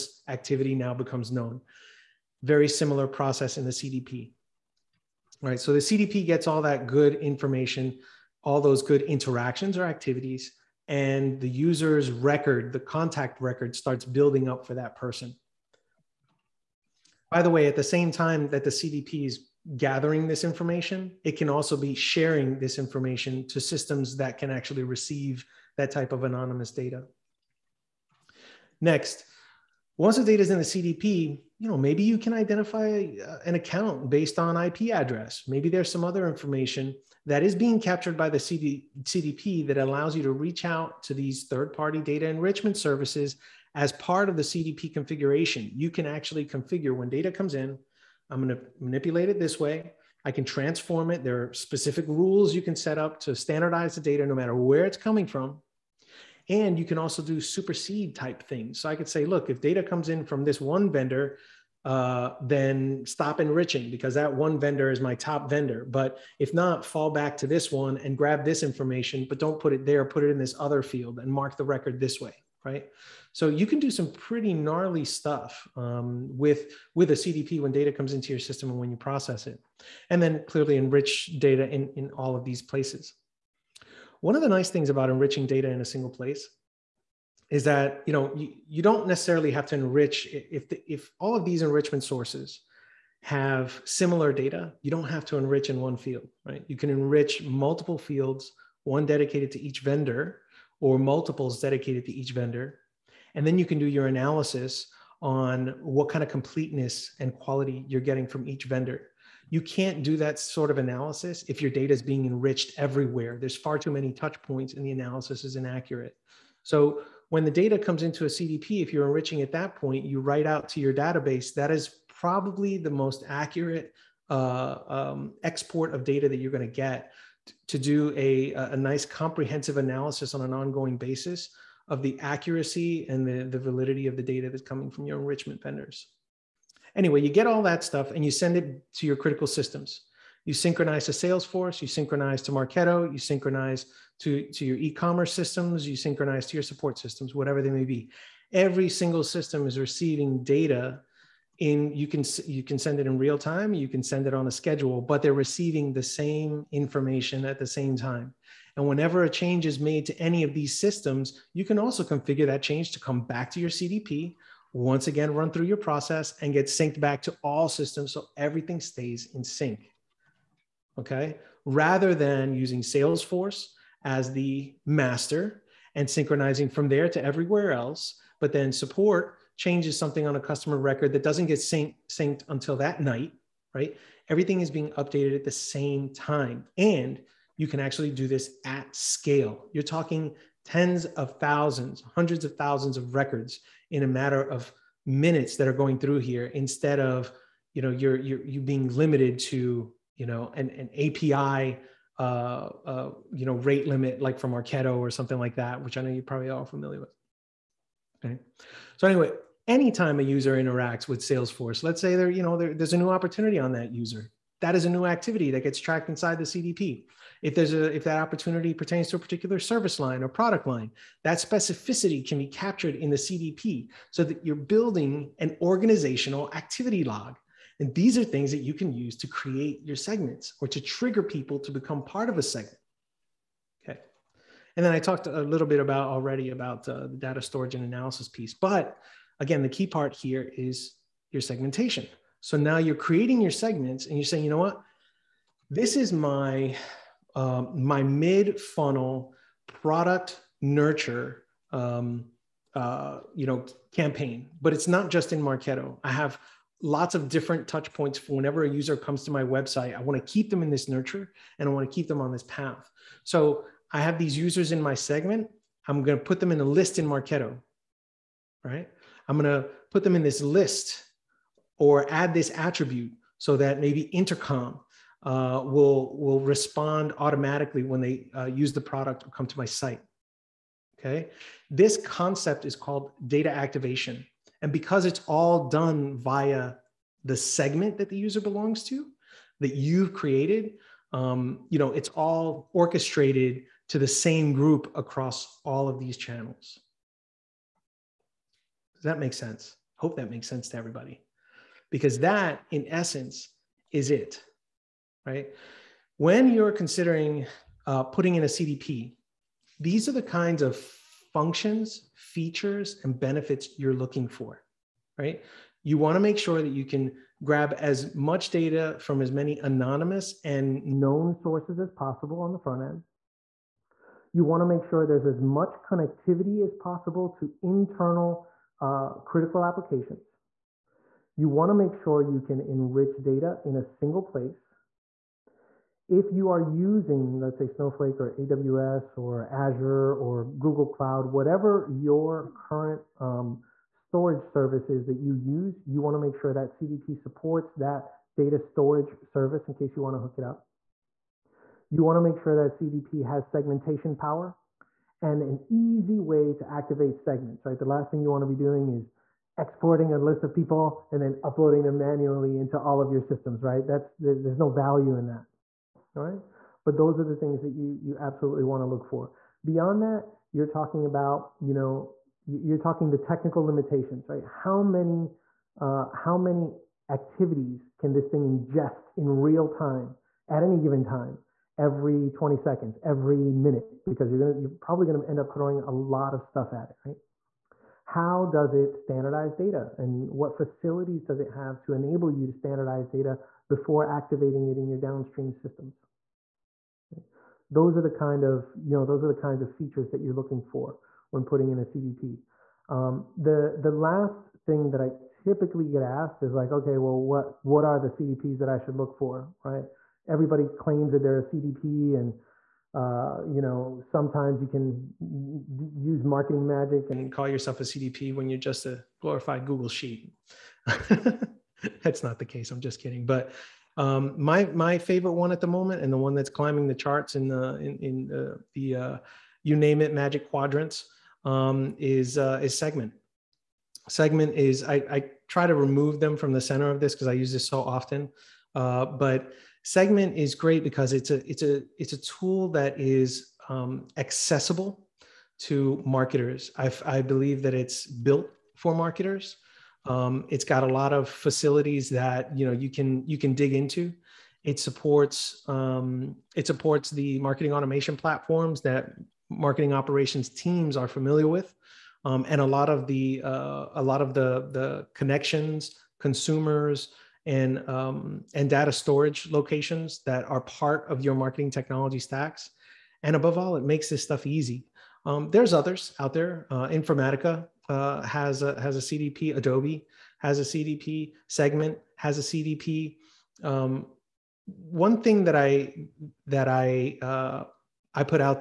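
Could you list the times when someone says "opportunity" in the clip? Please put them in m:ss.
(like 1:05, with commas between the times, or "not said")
3:33, 3:38.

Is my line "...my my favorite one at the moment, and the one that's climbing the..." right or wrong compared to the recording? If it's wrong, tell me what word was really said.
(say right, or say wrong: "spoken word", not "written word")
right.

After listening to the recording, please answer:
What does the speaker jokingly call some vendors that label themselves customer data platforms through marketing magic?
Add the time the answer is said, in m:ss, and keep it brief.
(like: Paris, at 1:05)
a glorified Google sheet, at 6:59.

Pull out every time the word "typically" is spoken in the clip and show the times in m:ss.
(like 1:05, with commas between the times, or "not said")
6:45.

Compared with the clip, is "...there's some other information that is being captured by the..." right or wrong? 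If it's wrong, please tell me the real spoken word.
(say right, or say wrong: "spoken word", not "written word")
right.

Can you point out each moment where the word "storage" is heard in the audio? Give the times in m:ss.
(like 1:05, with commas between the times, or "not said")
3:57, 5:43, 5:48, 7:48.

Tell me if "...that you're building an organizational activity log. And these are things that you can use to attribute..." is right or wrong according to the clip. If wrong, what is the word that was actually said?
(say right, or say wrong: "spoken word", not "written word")
wrong: "create", not "attribute".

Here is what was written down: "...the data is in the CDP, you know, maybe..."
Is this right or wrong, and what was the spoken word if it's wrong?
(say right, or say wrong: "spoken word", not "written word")
right.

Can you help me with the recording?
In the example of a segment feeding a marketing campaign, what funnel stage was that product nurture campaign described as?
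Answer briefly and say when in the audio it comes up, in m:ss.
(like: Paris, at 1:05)
mid funnel, at 4:08.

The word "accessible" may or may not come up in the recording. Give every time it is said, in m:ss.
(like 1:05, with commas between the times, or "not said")
7:24.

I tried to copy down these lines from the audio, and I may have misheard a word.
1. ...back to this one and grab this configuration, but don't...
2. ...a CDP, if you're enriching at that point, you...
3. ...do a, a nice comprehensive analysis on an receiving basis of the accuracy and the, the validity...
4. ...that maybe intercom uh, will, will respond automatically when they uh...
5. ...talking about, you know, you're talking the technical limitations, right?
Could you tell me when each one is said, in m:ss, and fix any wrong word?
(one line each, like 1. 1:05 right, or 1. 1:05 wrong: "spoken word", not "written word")
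1. 1:07 wrong: "information", not "configuration"
2. 1:58 right
3. 2:07 wrong: "ongoing", not "receiving"
4. 4:33 right
5. 6:10 right.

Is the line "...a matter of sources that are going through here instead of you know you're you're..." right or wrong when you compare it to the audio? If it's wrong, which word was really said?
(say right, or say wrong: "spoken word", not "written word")
wrong: "minutes", not "sources".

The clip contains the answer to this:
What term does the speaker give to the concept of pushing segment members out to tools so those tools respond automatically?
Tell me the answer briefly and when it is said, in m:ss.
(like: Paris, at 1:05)
data activation, at 4:43.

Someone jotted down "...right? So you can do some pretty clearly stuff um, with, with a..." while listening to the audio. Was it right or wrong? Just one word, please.
wrong.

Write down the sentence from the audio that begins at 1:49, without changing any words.
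You can't do that sort of analysis if your data is being enriched everywhere.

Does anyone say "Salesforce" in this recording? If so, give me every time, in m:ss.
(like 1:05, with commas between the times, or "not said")
2:21, 2:52, 3:31.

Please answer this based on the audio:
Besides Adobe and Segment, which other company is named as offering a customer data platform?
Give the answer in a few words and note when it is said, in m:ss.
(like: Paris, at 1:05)
Informatica, at 7:56.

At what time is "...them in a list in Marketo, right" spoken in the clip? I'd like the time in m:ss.
4:26.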